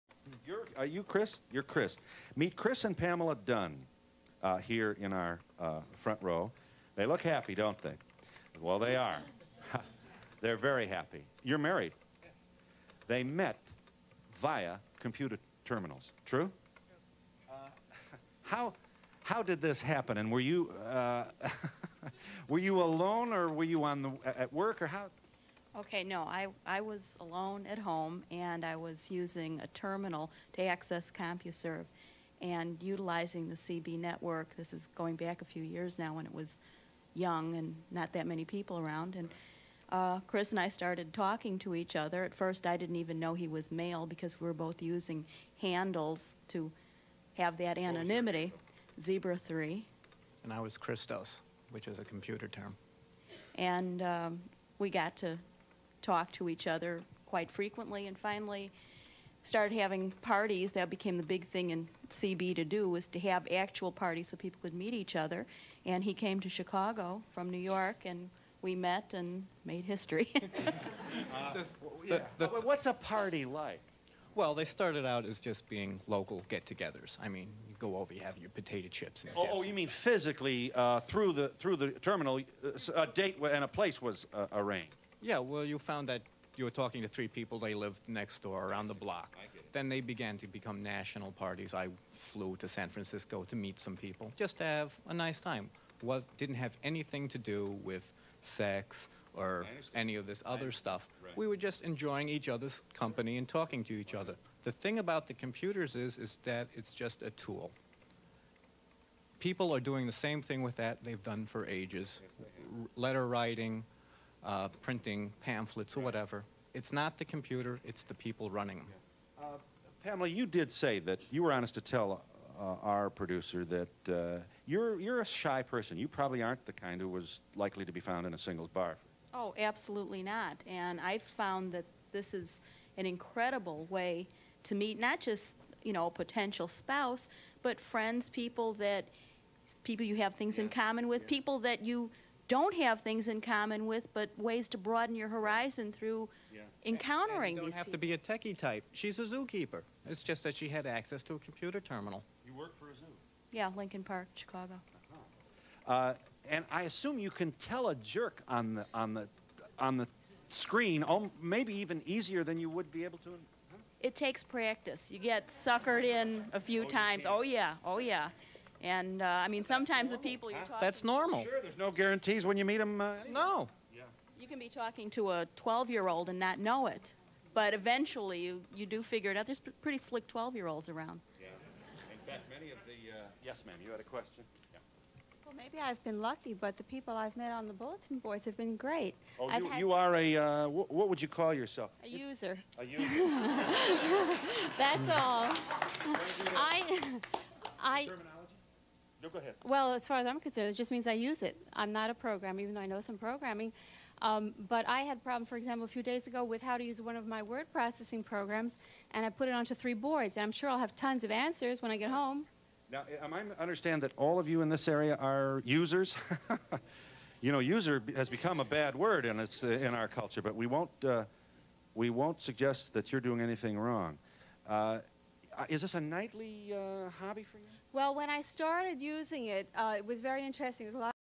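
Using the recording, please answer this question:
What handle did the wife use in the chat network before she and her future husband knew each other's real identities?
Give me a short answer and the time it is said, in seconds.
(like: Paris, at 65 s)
Christos, at 50 s.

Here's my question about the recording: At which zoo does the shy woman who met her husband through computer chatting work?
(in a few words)
Lincoln Park.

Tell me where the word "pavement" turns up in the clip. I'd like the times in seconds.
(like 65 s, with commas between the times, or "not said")
not said.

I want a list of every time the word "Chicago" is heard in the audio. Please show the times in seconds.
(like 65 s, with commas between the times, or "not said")
66 s, 154 s.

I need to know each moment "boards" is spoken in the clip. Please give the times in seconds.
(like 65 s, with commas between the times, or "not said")
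188 s, 209 s.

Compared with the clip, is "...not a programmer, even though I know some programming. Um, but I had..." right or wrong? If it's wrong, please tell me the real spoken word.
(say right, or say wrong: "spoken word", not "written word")
right.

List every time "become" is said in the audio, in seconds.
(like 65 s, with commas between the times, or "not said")
90 s, 218 s.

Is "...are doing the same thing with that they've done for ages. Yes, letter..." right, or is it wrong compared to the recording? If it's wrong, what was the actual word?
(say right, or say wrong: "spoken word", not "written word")
right.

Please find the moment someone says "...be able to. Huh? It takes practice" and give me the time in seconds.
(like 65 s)
162 s.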